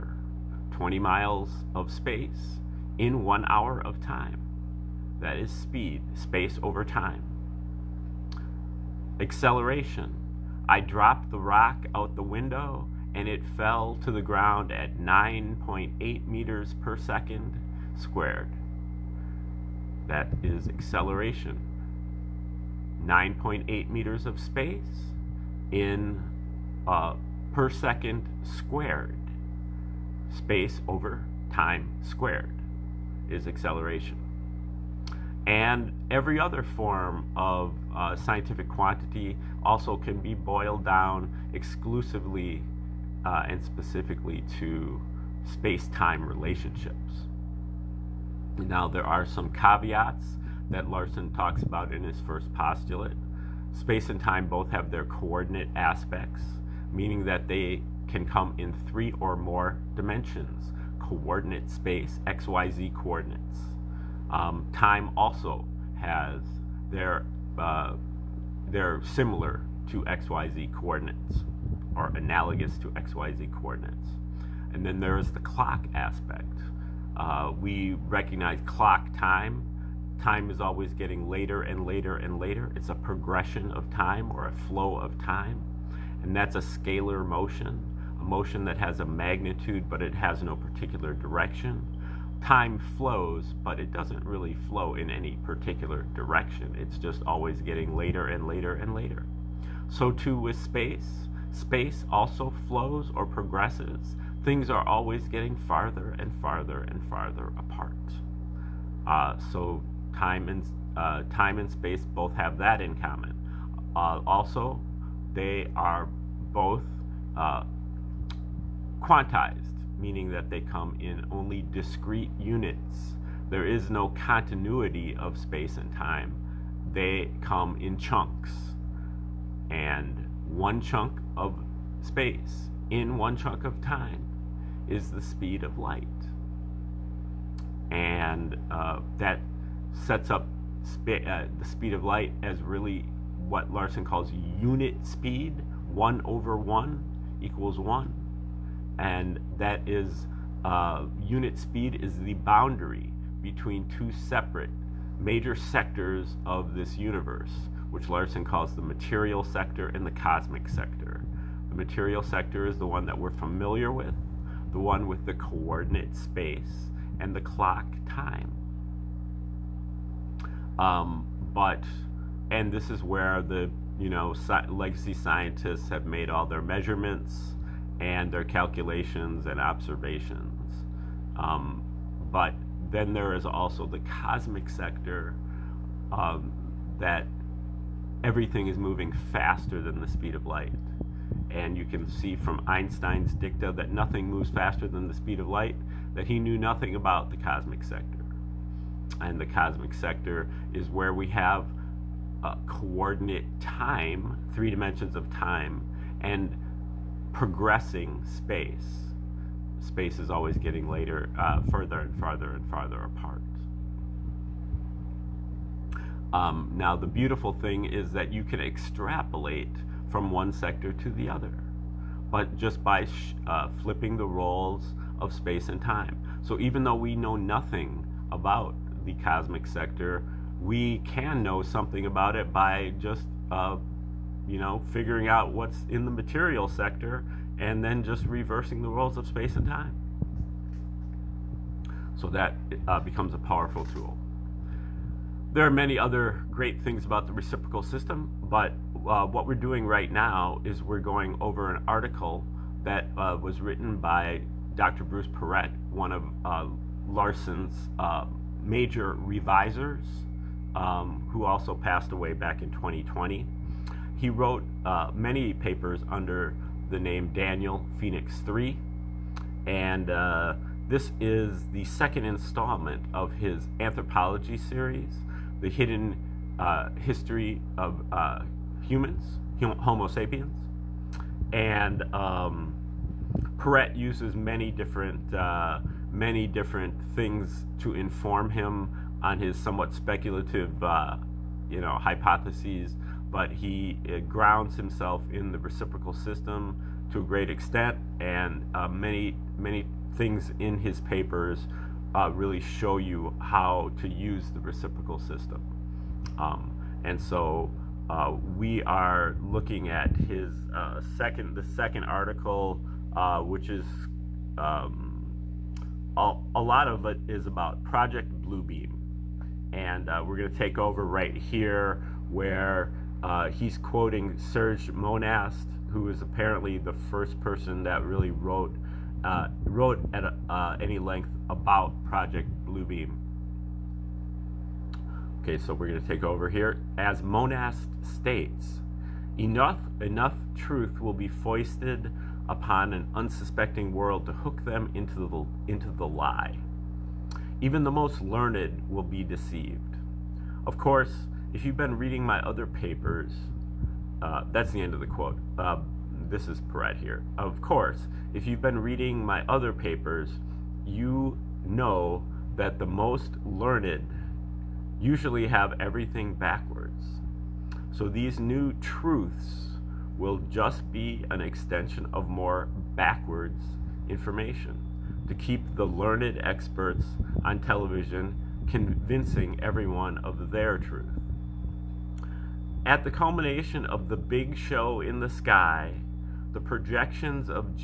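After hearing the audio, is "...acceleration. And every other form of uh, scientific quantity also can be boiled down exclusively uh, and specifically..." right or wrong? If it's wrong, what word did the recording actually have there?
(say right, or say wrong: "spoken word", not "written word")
right.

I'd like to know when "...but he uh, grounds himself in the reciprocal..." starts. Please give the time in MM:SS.
04:53.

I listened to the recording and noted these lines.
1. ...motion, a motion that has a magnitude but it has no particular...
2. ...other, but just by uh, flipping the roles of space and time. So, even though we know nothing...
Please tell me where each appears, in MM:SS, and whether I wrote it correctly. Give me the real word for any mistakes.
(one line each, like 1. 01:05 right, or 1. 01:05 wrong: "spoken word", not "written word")
1. 01:27 right
2. 03:41 right.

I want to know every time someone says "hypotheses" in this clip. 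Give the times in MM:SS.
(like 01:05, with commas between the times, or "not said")
04:51.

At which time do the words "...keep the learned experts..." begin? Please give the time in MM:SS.
06:15.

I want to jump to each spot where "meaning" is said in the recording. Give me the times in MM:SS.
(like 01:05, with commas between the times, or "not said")
00:56, 02:00.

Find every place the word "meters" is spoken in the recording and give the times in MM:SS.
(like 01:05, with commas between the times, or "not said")
00:16, 00:23.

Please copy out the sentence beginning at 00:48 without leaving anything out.
Now, there are some caveats that Larson talks about in his first postulate.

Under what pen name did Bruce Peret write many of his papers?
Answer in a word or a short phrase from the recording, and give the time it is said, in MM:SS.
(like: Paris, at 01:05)
Daniel Phoenix III, at 04:27.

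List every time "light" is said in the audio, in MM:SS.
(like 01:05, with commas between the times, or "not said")
02:15, 02:22, 03:10, 03:15.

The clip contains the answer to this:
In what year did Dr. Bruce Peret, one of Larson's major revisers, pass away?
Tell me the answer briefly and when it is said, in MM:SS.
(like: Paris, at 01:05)
2020, at 04:22.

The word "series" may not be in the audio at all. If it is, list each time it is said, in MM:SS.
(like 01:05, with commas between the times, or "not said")
04:34.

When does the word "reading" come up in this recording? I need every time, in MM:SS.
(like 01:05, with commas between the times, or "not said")
05:51, 05:58.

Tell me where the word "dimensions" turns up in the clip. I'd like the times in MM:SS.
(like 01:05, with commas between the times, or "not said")
00:59, 03:24.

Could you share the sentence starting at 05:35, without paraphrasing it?
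Okay, so we're going to take over here.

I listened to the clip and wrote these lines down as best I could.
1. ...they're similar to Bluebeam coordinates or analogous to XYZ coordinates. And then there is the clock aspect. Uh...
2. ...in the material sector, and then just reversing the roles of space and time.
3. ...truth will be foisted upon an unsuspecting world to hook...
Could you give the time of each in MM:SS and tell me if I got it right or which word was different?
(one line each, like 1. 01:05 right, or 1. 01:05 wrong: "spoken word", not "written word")
1. 01:08 wrong: "XYZ", not "Bluebeam"
2. 03:55 right
3. 05:40 right.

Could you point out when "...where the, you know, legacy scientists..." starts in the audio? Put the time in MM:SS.
02:53.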